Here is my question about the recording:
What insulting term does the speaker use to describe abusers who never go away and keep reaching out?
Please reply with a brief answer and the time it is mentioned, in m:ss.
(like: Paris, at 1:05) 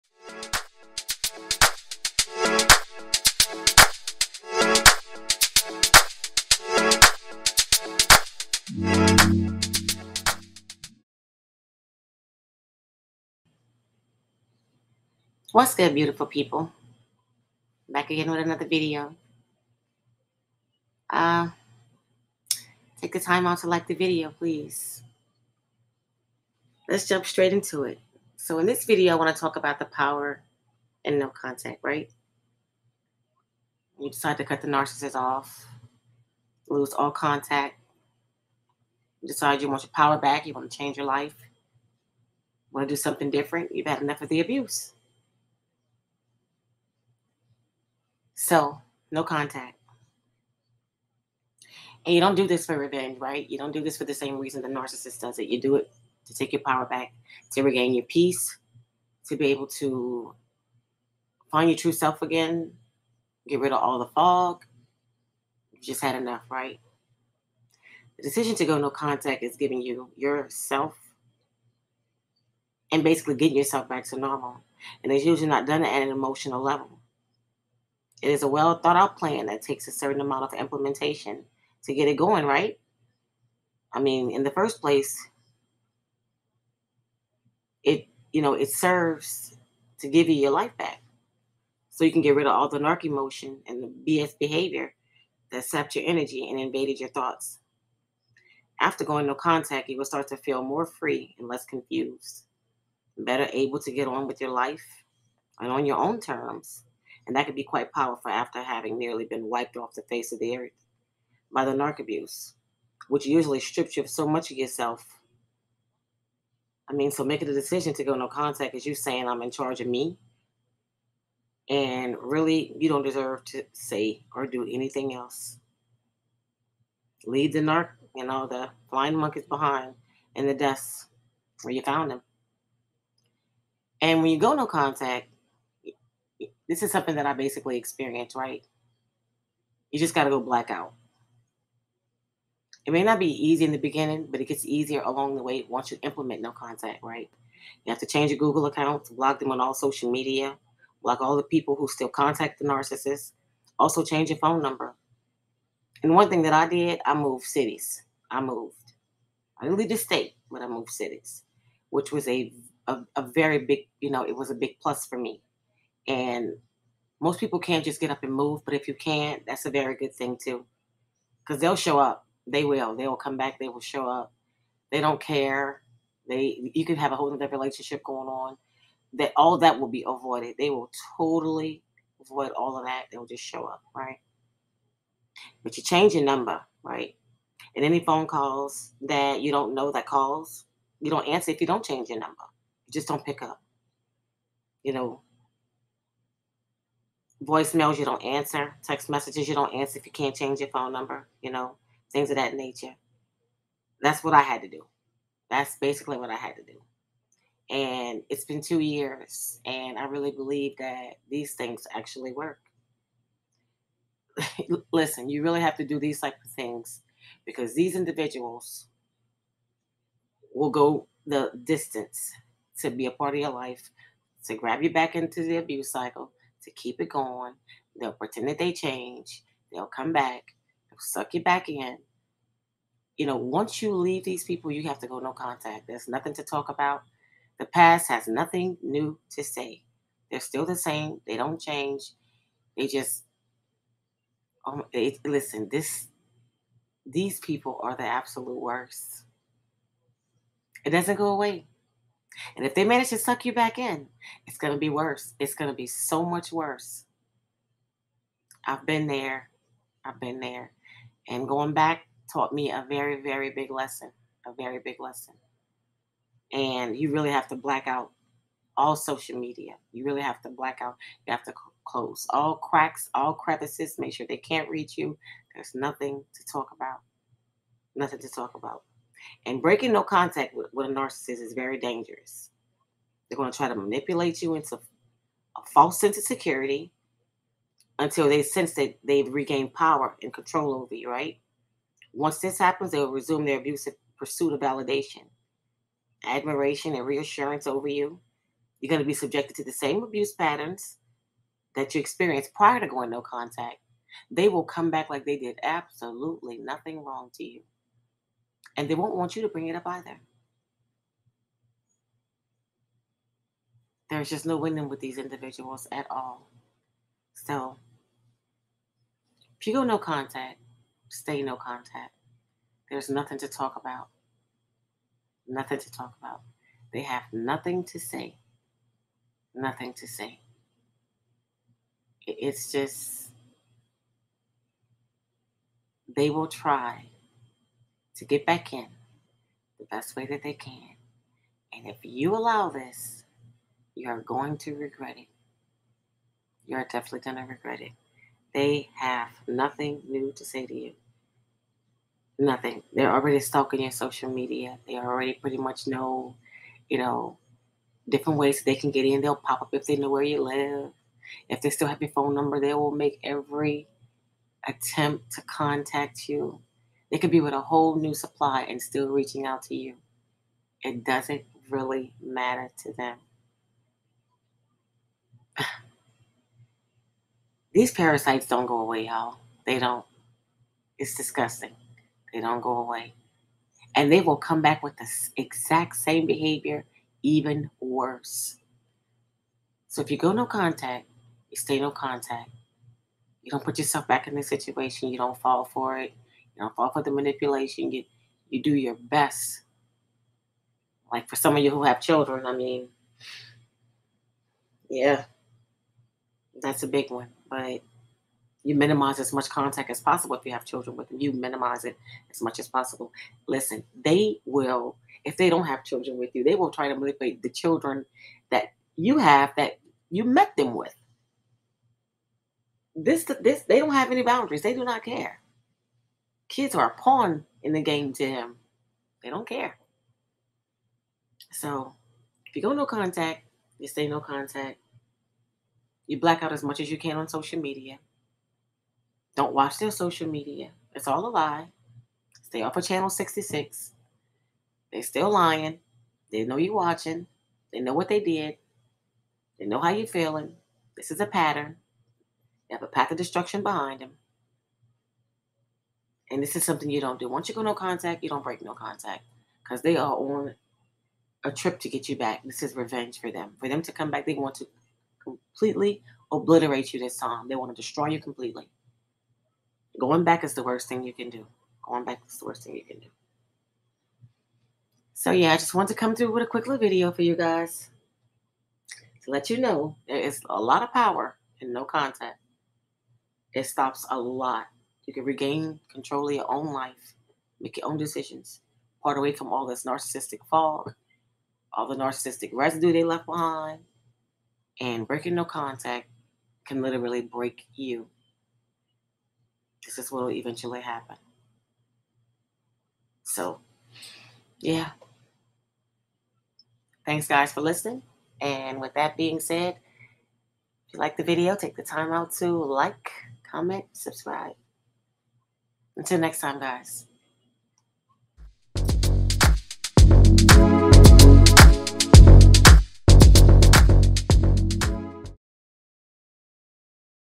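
parasites, at 6:17.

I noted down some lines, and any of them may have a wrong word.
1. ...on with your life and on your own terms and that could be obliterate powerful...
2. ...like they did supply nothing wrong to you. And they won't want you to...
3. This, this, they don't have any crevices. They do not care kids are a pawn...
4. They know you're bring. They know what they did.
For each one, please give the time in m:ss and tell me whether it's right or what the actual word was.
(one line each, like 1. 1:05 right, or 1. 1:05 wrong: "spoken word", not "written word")
1. 1:44 wrong: "quite", not "obliterate"
2. 5:05 wrong: "absolutely", not "supply"
3. 7:02 wrong: "boundaries", not "crevices"
4. 7:26 wrong: "watching", not "bring".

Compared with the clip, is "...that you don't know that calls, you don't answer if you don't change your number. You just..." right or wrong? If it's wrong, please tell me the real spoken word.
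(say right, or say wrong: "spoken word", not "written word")
right.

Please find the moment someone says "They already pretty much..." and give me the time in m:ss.
5:54.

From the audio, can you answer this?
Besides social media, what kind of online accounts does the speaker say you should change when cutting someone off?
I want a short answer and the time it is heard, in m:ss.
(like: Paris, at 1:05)
Google accounts, at 2:28.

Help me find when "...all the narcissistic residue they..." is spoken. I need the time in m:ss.
8:11.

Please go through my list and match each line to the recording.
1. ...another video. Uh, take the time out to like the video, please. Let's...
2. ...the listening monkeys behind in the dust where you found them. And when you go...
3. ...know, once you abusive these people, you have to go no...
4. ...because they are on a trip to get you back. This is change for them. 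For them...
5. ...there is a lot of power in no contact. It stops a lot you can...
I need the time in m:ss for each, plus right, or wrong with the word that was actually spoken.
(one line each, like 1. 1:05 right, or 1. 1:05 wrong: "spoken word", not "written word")
1. 0:18 right
2. 2:08 wrong: "flying", not "listening"
3. 3:53 wrong: "leave", not "abusive"
4. 7:39 wrong: "revenge", not "change"
5. 8:00 right.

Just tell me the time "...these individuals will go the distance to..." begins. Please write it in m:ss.
3:37.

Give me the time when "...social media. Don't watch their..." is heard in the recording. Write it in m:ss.
7:17.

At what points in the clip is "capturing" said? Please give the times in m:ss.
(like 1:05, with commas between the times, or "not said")
not said.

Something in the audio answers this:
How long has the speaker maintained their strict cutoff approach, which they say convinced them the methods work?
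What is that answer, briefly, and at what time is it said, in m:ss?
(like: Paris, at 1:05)
2 years, at 3:28.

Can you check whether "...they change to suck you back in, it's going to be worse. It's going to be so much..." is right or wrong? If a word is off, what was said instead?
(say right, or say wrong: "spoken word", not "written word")
wrong: "manage", not "change".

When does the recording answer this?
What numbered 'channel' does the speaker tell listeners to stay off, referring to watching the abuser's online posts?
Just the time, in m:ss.
7:22.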